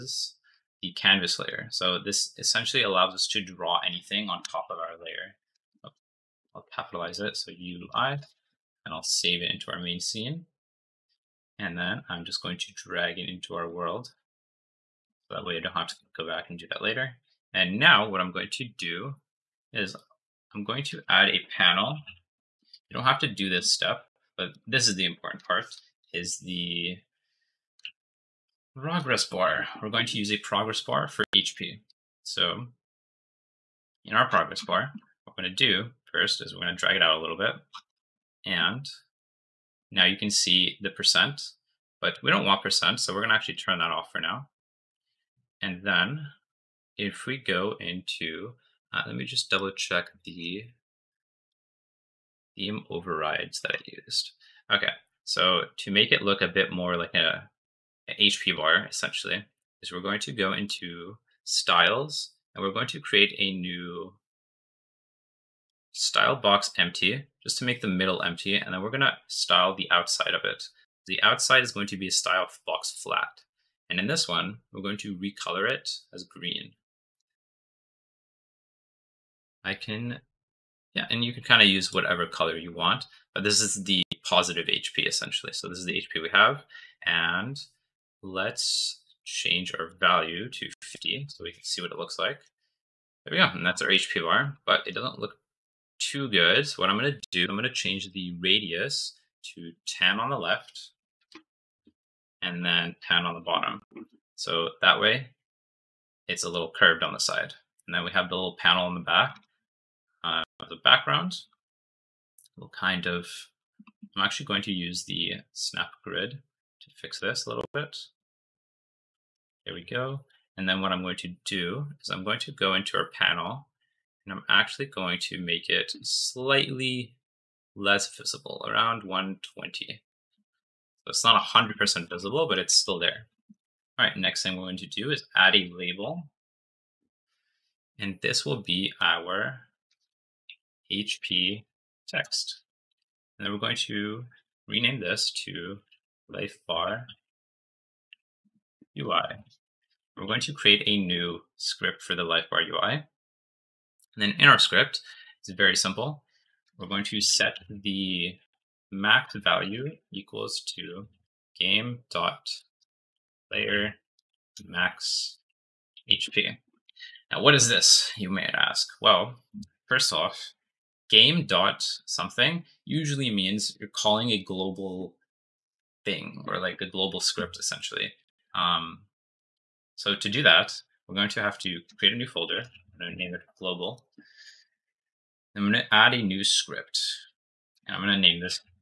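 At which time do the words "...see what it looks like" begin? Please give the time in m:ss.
1:31.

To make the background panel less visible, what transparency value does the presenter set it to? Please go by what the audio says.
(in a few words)
120.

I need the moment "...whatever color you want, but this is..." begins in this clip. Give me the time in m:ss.
1:21.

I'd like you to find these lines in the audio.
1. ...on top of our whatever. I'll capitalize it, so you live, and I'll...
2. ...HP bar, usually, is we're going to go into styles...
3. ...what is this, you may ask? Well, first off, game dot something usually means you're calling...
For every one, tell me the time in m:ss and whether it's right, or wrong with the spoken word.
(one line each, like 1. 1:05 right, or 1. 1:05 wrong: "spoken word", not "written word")
1. 0:04 wrong: "layer", not "whatever"
2. 0:58 wrong: "essentially", not "usually"
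3. 2:47 right.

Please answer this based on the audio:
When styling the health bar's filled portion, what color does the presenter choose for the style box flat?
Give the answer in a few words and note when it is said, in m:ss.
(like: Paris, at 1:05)
Green, at 1:16.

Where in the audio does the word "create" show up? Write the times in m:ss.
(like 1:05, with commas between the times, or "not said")
1:02, 2:30, 3:01.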